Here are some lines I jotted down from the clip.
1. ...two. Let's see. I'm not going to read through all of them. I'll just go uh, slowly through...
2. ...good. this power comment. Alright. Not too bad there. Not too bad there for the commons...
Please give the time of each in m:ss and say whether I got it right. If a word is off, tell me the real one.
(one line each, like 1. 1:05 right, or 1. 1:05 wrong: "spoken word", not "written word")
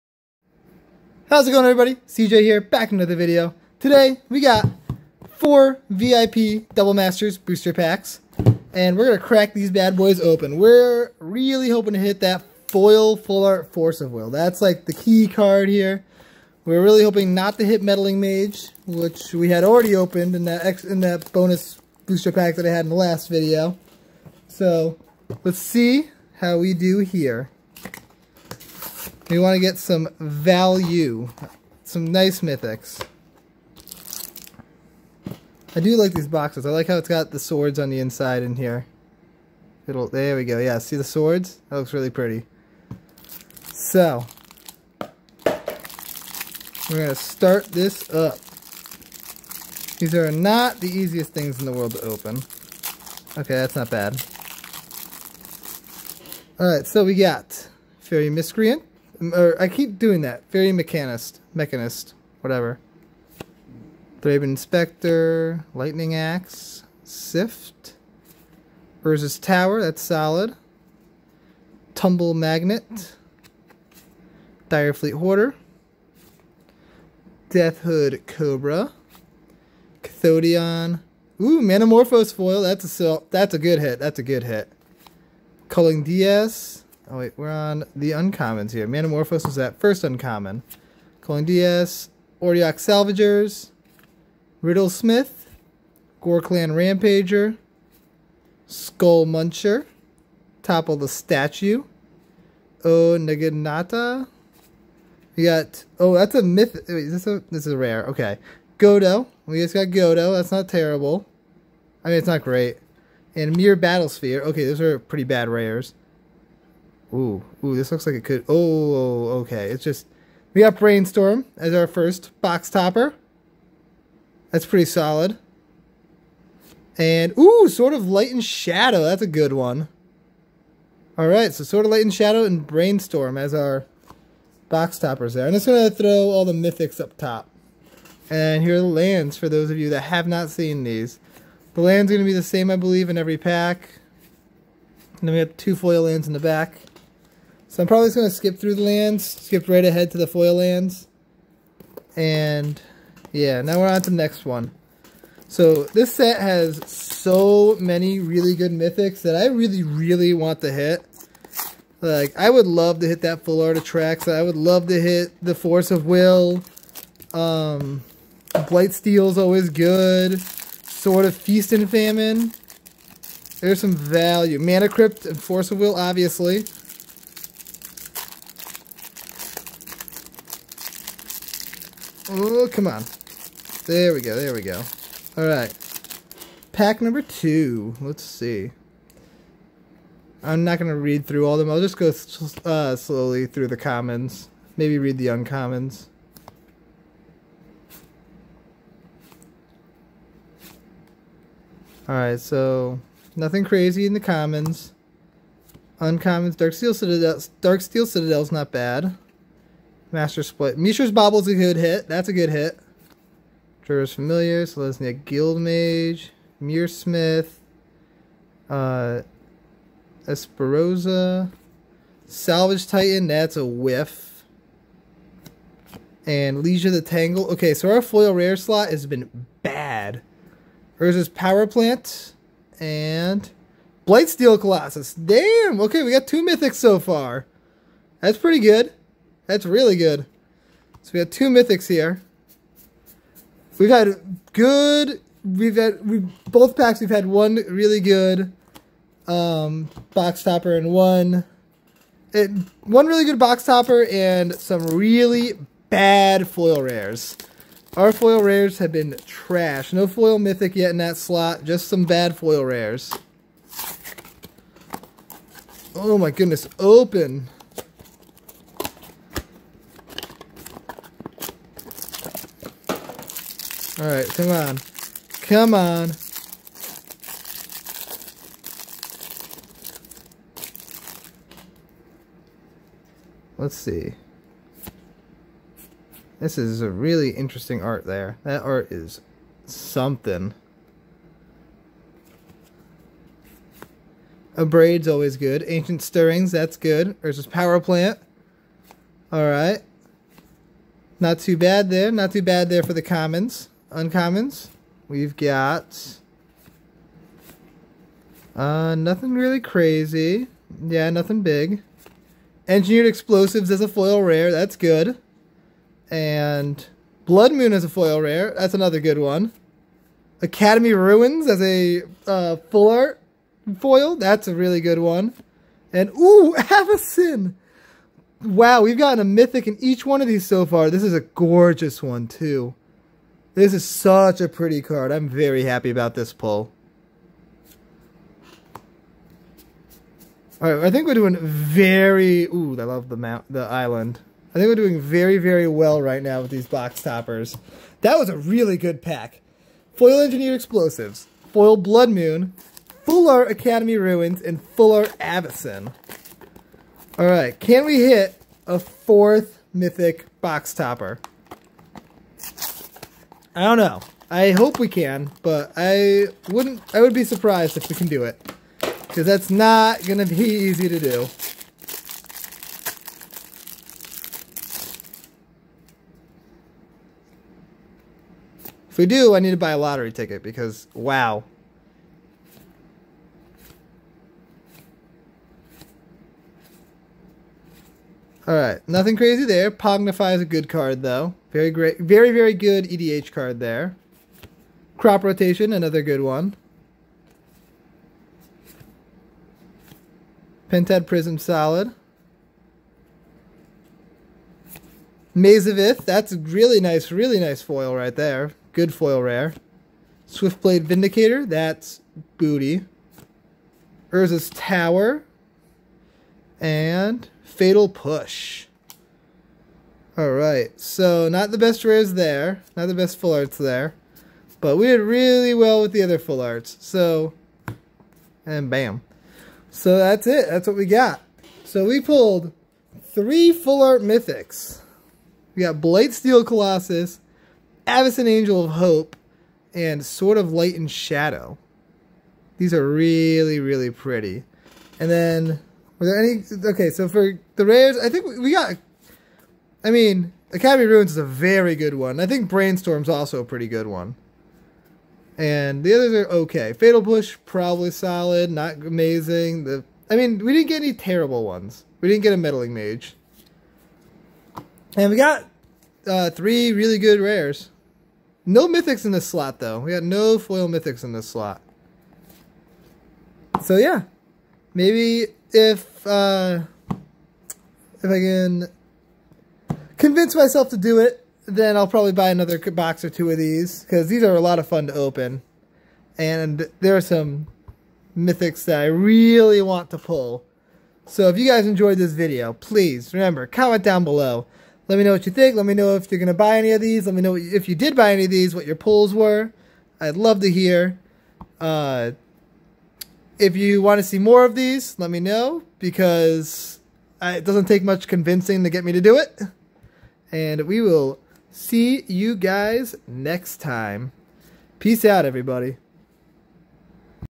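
1. 3:07 right
2. 4:56 wrong: "plant", not "comment".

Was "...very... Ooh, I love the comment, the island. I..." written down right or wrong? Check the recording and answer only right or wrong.
wrong.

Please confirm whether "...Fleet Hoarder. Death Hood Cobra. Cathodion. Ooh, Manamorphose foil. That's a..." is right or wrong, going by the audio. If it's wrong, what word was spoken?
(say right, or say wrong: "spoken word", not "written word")
right.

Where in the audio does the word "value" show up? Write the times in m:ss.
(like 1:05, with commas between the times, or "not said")
0:30, 2:53.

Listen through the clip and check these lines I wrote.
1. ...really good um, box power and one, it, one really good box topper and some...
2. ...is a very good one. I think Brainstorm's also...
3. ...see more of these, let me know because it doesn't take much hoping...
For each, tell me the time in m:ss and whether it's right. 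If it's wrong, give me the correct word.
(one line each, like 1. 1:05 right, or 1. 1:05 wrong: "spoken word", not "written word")
1. 4:07 wrong: "topper", not "power"
2. 7:31 right
3. 8:24 wrong: "convincing", not "hoping".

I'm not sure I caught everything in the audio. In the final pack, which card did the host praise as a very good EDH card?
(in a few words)
Pongify.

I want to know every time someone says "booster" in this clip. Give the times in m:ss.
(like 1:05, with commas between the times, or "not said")
0:07, 0:22.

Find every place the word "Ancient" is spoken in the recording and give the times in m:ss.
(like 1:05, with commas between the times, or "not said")
4:55.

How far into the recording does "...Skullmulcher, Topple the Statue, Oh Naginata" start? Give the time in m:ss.
1:38.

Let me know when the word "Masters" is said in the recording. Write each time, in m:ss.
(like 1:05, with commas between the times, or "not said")
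0:06, 3:30.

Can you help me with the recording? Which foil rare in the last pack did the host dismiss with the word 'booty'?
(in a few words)
Swiftblade Vindicator.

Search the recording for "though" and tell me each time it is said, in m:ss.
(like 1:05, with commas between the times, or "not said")
6:31, 7:49.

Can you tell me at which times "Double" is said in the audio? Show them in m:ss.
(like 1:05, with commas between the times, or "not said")
0:06.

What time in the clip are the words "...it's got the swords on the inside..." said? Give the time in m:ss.
0:36.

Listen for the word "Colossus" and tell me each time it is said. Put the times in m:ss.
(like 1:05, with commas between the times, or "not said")
3:54, 7:16.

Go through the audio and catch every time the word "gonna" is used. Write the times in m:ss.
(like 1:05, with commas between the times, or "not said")
0:09, 2:15, 2:22, 6:10.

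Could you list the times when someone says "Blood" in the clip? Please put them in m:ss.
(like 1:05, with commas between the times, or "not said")
5:17, 5:51.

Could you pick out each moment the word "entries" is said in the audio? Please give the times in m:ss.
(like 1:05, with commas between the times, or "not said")
not said.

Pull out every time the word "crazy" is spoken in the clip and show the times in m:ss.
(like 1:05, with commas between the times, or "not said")
3:23, 5:09, 6:29.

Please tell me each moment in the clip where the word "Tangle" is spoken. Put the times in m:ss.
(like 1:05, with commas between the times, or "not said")
3:47.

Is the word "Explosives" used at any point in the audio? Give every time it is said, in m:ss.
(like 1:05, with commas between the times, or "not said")
5:13, 5:50.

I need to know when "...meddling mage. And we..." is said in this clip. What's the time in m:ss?
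7:42.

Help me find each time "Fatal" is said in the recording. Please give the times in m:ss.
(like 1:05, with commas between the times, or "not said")
6:57, 7:36.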